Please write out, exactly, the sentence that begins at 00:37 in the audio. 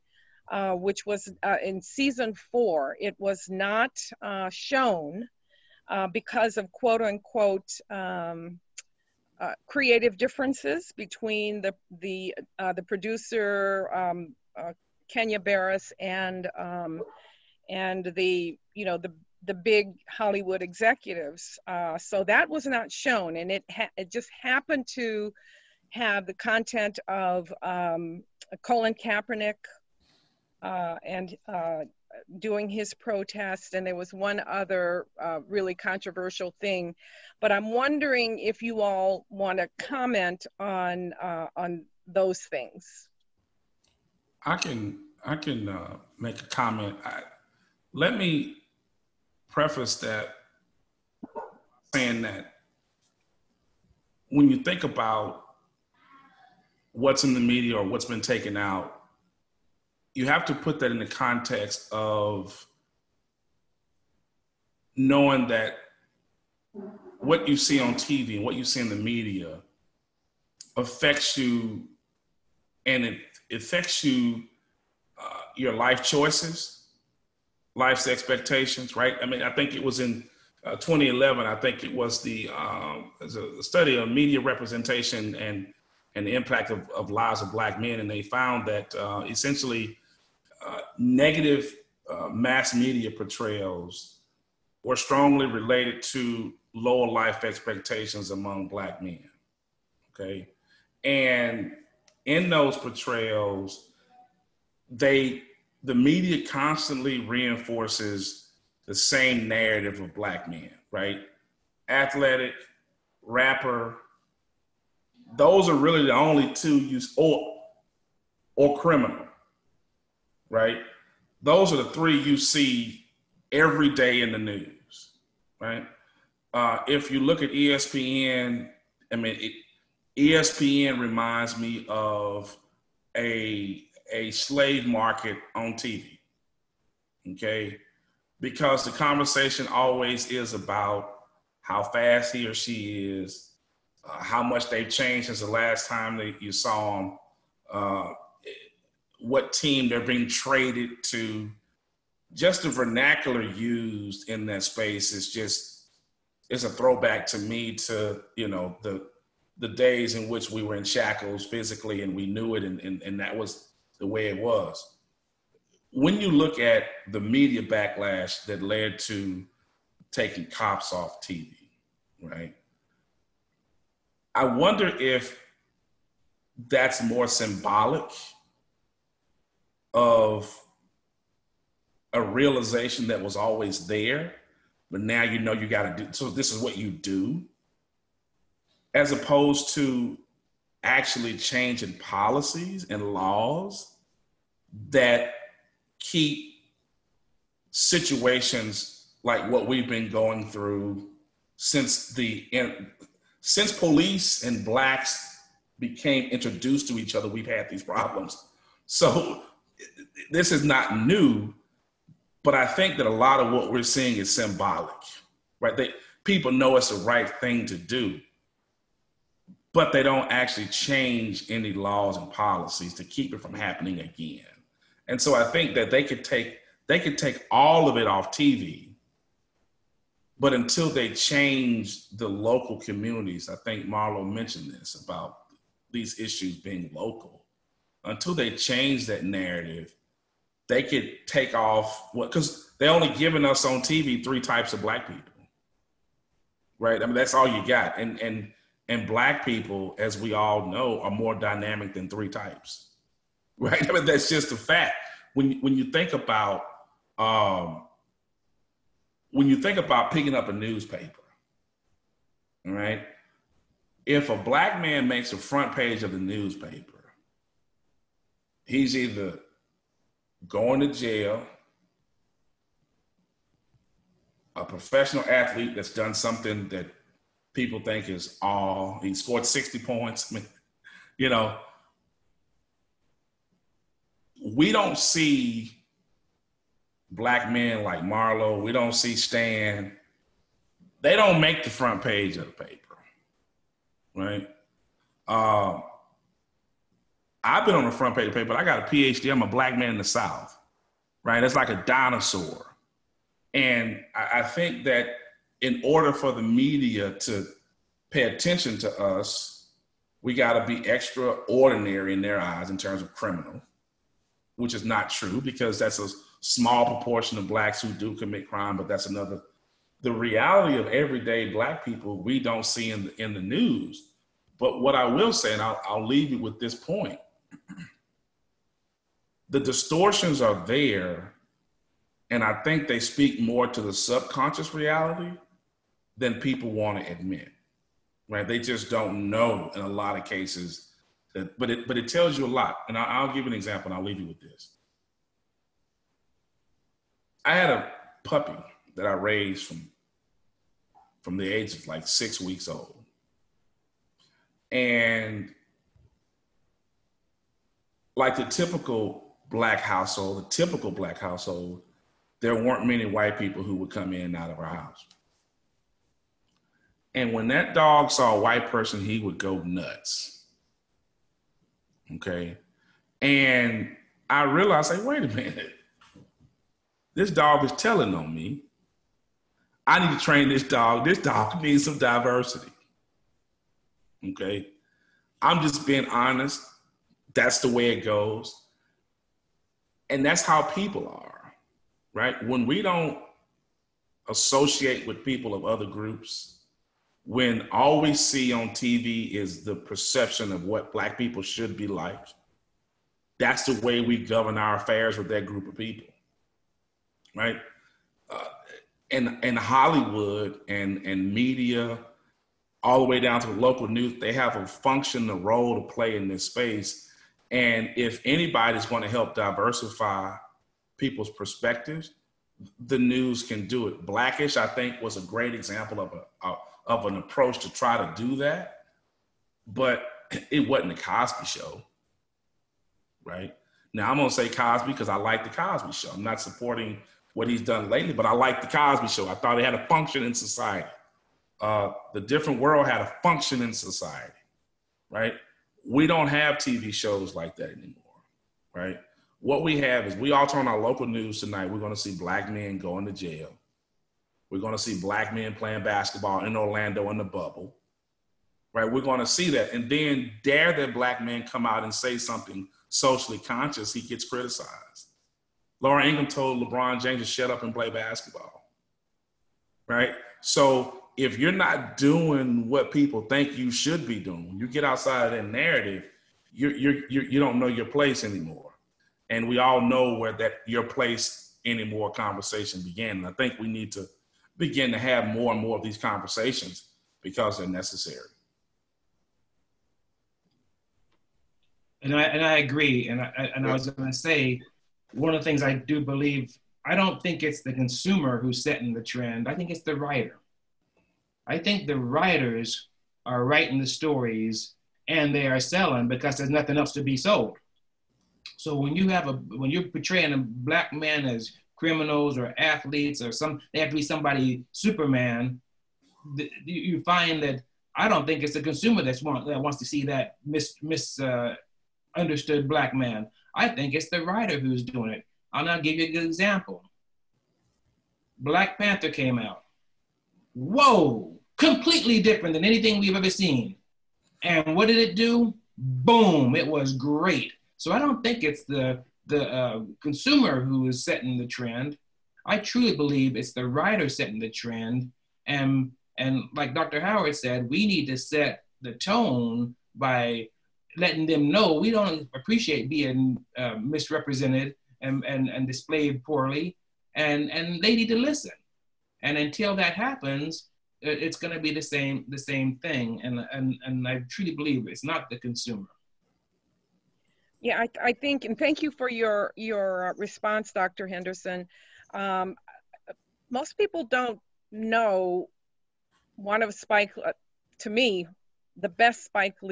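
But I'm wondering if you all want to comment on uh, on those things.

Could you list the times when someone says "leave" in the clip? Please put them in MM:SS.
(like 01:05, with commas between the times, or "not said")
05:26, 05:44.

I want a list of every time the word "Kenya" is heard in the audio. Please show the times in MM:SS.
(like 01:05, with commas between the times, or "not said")
00:15.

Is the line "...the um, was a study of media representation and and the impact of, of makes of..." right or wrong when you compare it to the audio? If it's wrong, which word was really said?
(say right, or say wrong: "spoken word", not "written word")
wrong: "lives", not "makes".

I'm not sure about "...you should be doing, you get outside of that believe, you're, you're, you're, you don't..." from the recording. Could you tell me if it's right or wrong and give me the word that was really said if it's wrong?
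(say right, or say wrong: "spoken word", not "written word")
wrong: "narrative", not "believe".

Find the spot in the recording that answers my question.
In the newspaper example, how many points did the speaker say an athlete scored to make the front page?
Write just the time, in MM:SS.
04:39.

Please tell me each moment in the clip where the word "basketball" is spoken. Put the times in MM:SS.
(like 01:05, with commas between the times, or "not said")
07:35, 07:47.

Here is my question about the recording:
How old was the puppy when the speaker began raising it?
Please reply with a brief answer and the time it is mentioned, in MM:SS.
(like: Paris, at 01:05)
six weeks, at 05:52.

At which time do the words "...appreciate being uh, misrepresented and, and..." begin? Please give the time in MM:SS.
09:12.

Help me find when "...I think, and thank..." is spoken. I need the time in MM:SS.
09:28.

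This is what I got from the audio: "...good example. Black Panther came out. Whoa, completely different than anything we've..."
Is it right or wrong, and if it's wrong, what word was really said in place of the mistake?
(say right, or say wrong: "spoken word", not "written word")
right.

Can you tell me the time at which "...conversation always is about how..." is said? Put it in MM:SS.
02:18.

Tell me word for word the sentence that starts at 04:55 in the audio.
Uh, I've been on the front page of the paper.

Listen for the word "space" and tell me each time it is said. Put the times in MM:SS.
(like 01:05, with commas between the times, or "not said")
02:34, 06:56.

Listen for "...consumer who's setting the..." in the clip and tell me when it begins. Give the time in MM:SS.
08:17.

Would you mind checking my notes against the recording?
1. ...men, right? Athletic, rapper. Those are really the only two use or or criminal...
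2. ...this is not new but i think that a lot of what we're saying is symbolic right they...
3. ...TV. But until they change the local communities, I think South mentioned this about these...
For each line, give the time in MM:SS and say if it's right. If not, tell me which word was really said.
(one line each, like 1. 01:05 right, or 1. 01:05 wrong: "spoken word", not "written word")
1. 01:50 right
2. 03:30 wrong: "seeing", not "saying"
3. 03:48 wrong: "Marlo", not "South".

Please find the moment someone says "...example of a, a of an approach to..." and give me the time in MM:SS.
07:05.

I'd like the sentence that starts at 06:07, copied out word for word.
And when that dog saw a white person, he would go nuts.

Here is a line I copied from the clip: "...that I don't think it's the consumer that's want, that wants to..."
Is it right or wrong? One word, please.
right.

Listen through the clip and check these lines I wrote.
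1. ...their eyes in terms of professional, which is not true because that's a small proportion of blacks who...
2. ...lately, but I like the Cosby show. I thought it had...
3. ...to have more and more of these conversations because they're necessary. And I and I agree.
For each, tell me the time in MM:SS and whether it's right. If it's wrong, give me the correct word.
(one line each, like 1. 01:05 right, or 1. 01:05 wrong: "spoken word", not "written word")
1. 05:12 wrong: "criminal", not "professional"
2. 07:17 right
3. 08:04 right.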